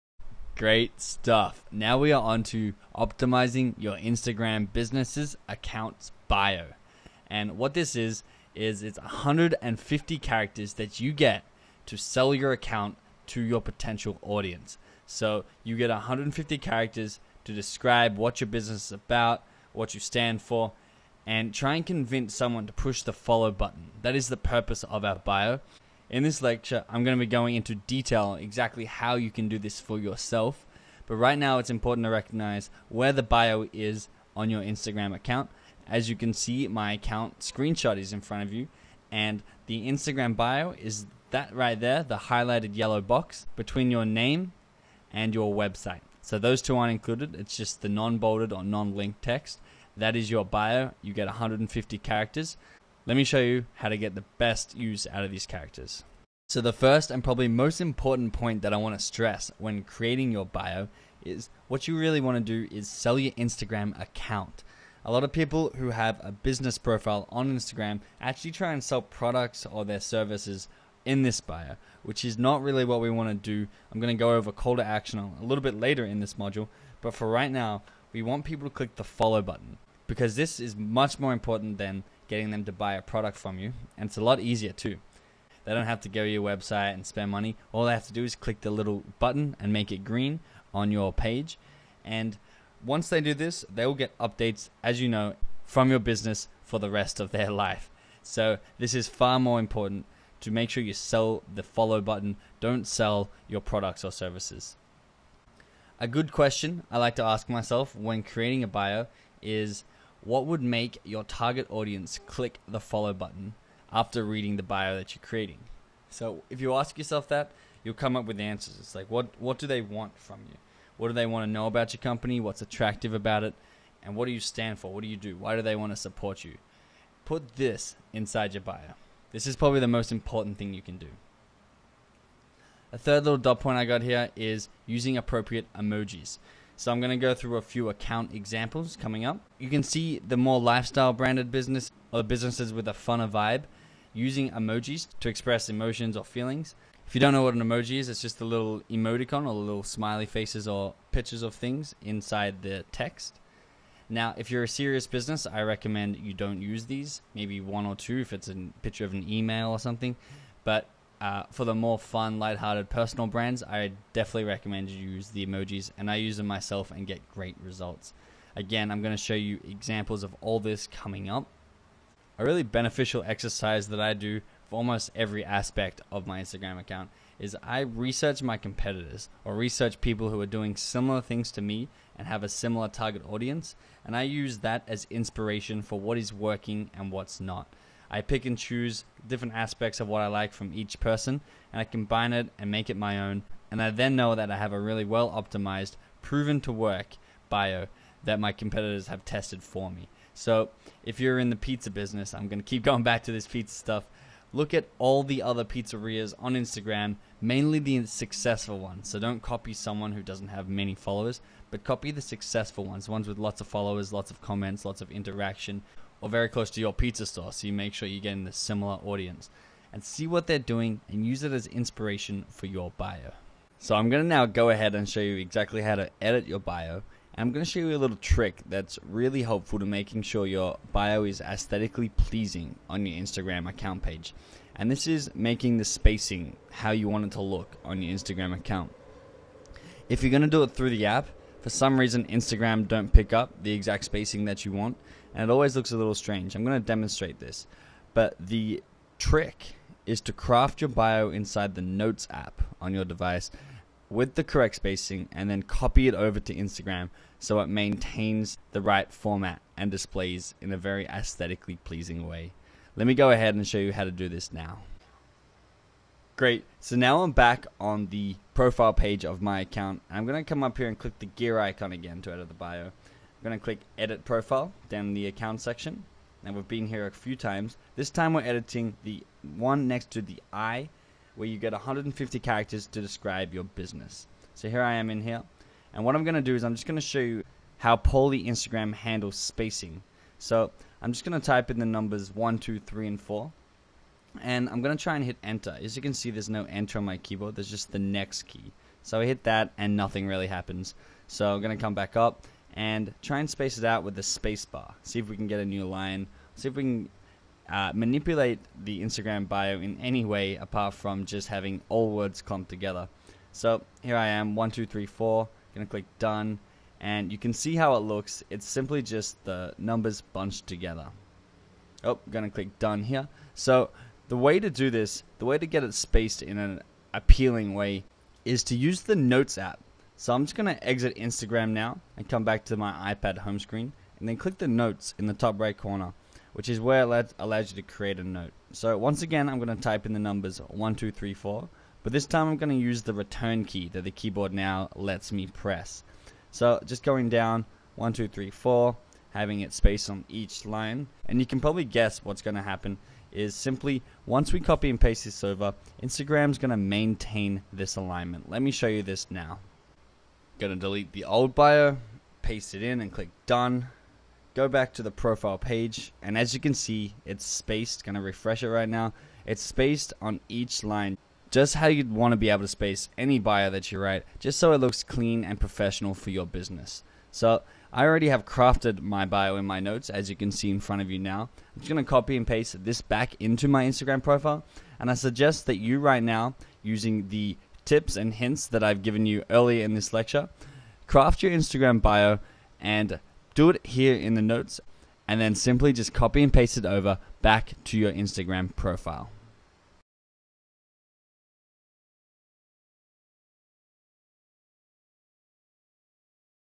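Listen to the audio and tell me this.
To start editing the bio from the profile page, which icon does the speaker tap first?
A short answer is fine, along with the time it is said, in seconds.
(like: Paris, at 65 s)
gear icon, at 271 s.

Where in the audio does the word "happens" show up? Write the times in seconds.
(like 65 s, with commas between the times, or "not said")
300 s, 352 s.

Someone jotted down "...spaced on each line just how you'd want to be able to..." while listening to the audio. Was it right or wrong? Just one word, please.
right.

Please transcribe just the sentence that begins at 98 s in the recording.
So this is far more important to make sure you sell the follow button.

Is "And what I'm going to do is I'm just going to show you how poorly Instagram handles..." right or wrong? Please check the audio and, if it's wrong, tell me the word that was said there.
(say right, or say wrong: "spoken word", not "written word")
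right.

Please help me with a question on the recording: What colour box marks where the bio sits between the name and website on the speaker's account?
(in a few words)
yellow.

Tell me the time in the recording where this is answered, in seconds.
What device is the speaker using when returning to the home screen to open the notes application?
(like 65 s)
333 s.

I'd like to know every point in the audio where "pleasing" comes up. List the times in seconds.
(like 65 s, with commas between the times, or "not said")
232 s, 261 s.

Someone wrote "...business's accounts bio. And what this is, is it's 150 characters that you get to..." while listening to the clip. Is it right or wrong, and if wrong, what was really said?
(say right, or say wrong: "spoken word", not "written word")
right.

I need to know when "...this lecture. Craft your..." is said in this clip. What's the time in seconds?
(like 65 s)
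389 s.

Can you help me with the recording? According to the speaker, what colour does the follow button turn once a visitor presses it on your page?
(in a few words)
green.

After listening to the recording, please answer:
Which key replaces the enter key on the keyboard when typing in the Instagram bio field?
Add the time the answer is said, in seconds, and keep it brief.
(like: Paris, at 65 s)
next key, at 297 s.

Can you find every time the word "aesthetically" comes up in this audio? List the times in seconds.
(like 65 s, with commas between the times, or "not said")
231 s, 261 s.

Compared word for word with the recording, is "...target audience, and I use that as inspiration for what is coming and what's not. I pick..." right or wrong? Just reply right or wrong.
wrong.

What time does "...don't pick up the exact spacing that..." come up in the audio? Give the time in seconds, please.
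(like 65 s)
242 s.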